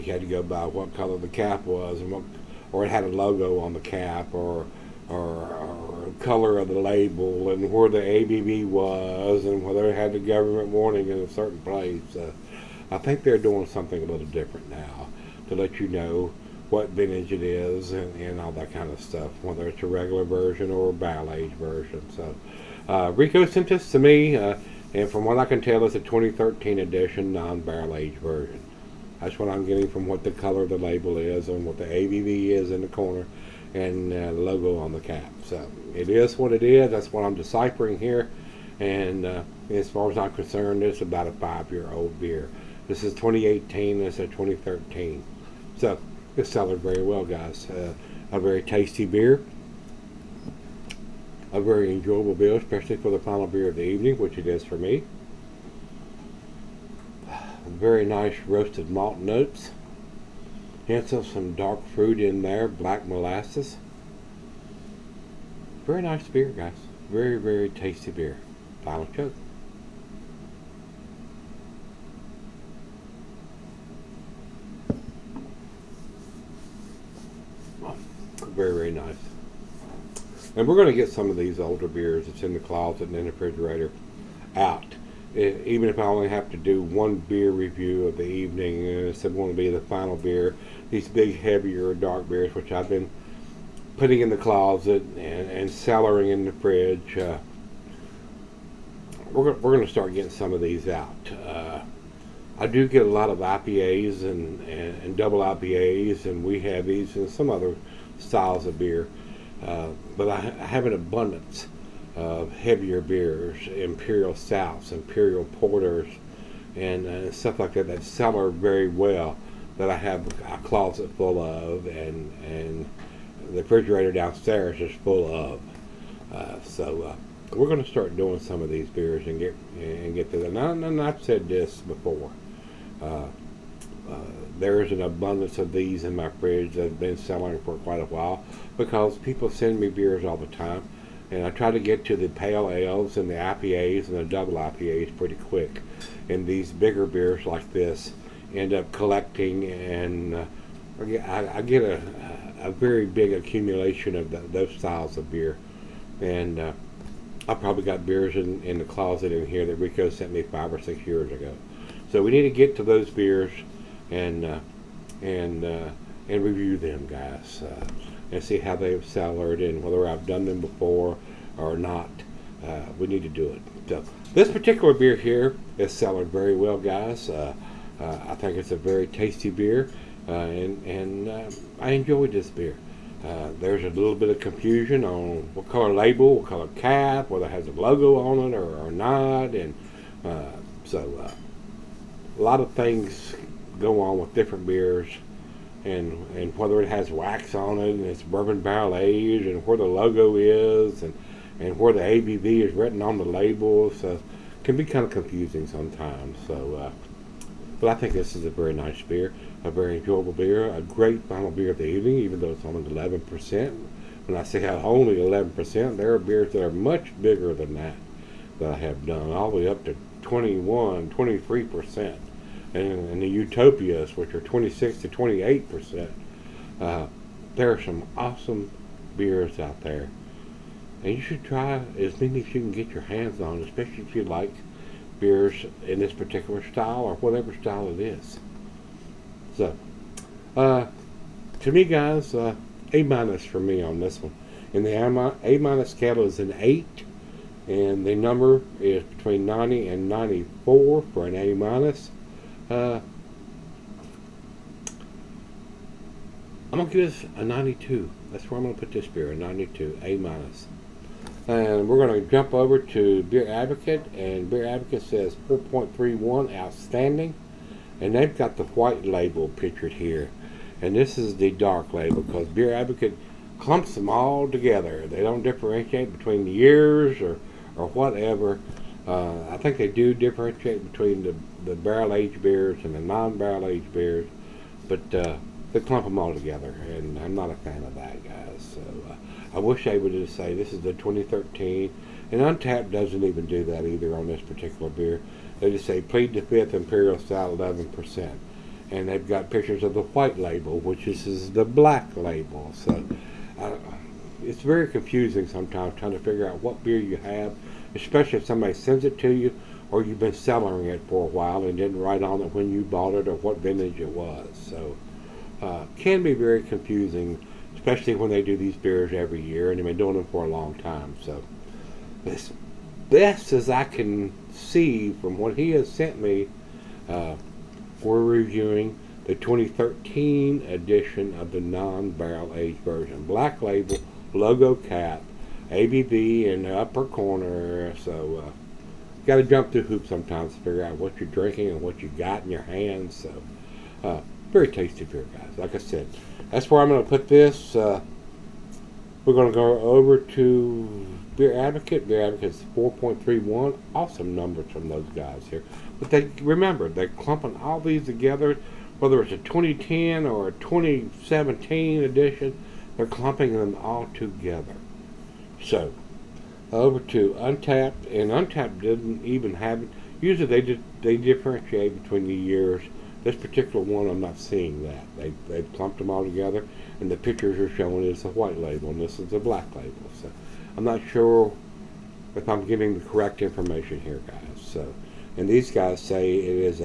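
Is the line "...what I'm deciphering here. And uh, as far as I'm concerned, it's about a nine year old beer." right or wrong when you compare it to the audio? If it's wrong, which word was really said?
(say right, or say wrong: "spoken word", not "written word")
wrong: "five", not "nine".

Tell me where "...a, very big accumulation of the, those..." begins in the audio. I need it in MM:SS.
02:32.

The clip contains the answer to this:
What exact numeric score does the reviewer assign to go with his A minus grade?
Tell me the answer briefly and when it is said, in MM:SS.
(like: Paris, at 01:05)
92, at 04:16.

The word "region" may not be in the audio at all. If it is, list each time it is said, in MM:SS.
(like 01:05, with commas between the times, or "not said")
not said.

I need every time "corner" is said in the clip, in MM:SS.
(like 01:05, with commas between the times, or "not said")
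00:32, 05:37.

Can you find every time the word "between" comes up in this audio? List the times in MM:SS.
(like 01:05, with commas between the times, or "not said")
04:09, 04:36, 04:40, 06:12.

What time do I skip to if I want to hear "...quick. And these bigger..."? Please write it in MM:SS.
02:25.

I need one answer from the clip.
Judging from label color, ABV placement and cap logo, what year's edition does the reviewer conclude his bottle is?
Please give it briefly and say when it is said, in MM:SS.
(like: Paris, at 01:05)
2013, at 00:25.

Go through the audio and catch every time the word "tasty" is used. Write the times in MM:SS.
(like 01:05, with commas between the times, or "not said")
00:48, 01:07, 02:59, 05:44.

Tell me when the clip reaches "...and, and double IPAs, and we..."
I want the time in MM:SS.
01:44.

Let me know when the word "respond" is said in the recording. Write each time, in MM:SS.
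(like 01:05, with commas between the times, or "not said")
not said.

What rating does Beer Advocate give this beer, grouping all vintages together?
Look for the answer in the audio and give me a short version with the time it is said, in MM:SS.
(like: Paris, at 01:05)
4.31, at 04:24.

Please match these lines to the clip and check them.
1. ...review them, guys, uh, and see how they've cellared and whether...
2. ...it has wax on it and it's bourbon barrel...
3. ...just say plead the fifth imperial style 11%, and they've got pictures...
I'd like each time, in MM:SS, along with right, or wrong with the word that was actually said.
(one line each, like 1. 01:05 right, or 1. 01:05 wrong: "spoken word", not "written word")
1. 02:46 right
2. 03:16 right
3. 04:55 right.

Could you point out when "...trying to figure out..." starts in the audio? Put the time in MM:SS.
05:05.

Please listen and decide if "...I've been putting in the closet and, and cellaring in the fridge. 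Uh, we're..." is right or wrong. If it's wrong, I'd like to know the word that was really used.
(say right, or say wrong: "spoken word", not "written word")
right.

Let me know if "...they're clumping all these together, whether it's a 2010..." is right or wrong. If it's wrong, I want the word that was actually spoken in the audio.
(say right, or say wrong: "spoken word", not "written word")
right.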